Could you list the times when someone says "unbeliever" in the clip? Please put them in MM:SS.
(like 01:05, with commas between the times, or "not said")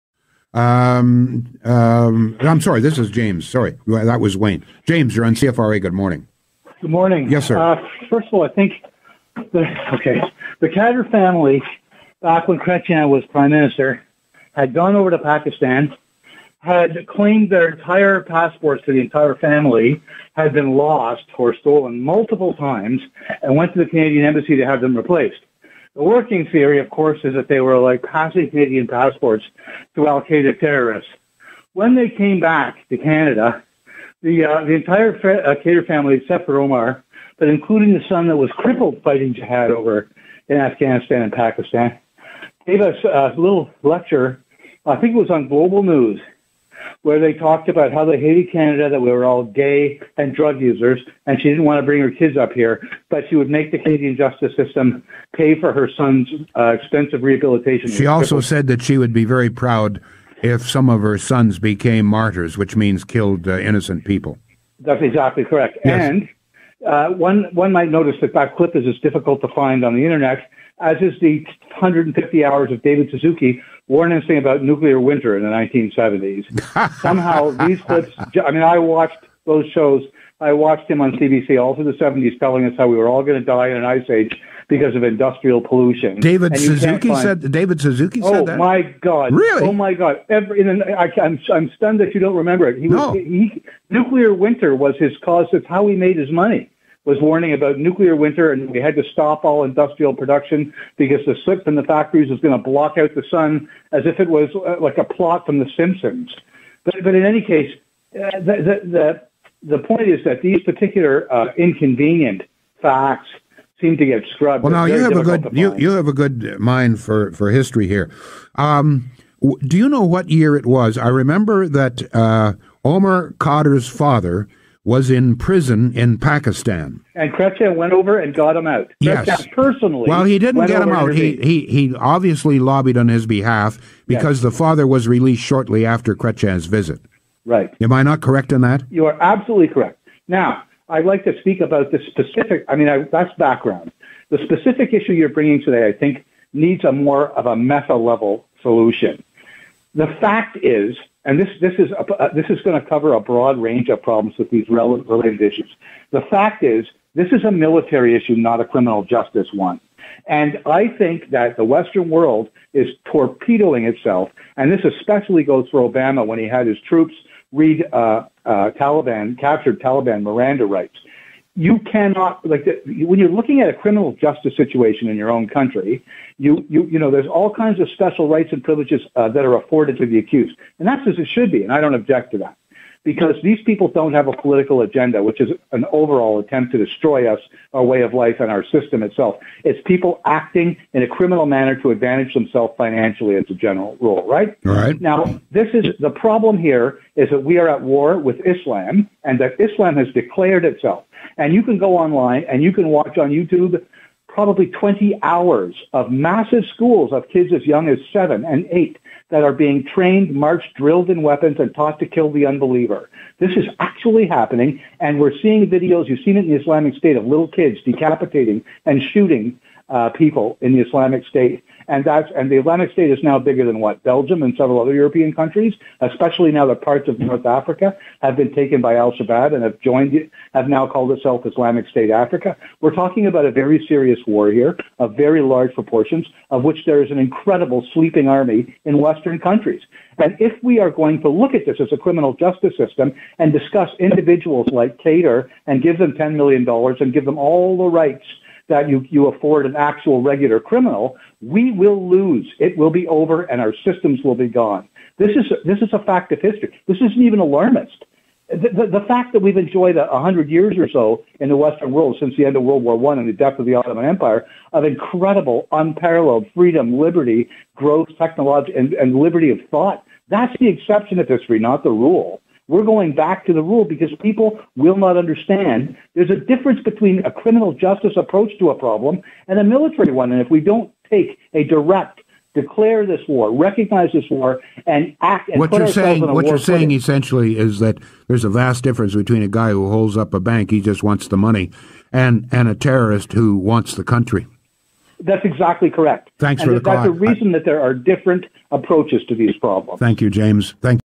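03:32.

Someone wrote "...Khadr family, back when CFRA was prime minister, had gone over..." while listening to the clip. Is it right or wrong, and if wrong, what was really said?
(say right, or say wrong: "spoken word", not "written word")
wrong: "Chrétien", not "CFRA".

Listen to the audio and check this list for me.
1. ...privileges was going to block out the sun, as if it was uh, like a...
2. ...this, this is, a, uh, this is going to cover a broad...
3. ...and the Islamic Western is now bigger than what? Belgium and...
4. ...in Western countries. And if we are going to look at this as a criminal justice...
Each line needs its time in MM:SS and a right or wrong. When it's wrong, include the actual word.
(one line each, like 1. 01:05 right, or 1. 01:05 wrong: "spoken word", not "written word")
1. 01:41 wrong: "factories", not "privileges"
2. 02:31 right
3. 03:42 wrong: "State", not "Western"
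4. 03:58 right.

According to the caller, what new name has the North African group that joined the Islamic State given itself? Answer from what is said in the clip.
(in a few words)
Islamic State Africa.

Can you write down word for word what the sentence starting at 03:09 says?
It's people acting in a criminal manner to advantage themselves financially as a general rule, right?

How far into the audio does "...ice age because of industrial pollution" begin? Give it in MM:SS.
01:23.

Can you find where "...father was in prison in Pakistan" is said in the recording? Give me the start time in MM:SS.
02:03.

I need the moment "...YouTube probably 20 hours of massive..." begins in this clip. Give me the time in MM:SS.
03:23.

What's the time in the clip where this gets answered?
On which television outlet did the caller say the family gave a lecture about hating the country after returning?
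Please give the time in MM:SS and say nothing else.
00:45.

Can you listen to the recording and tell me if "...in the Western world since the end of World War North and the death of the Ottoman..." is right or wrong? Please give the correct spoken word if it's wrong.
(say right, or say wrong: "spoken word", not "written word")
wrong: "One", not "North".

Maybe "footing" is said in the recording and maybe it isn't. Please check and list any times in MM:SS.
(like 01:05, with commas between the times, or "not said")
04:46.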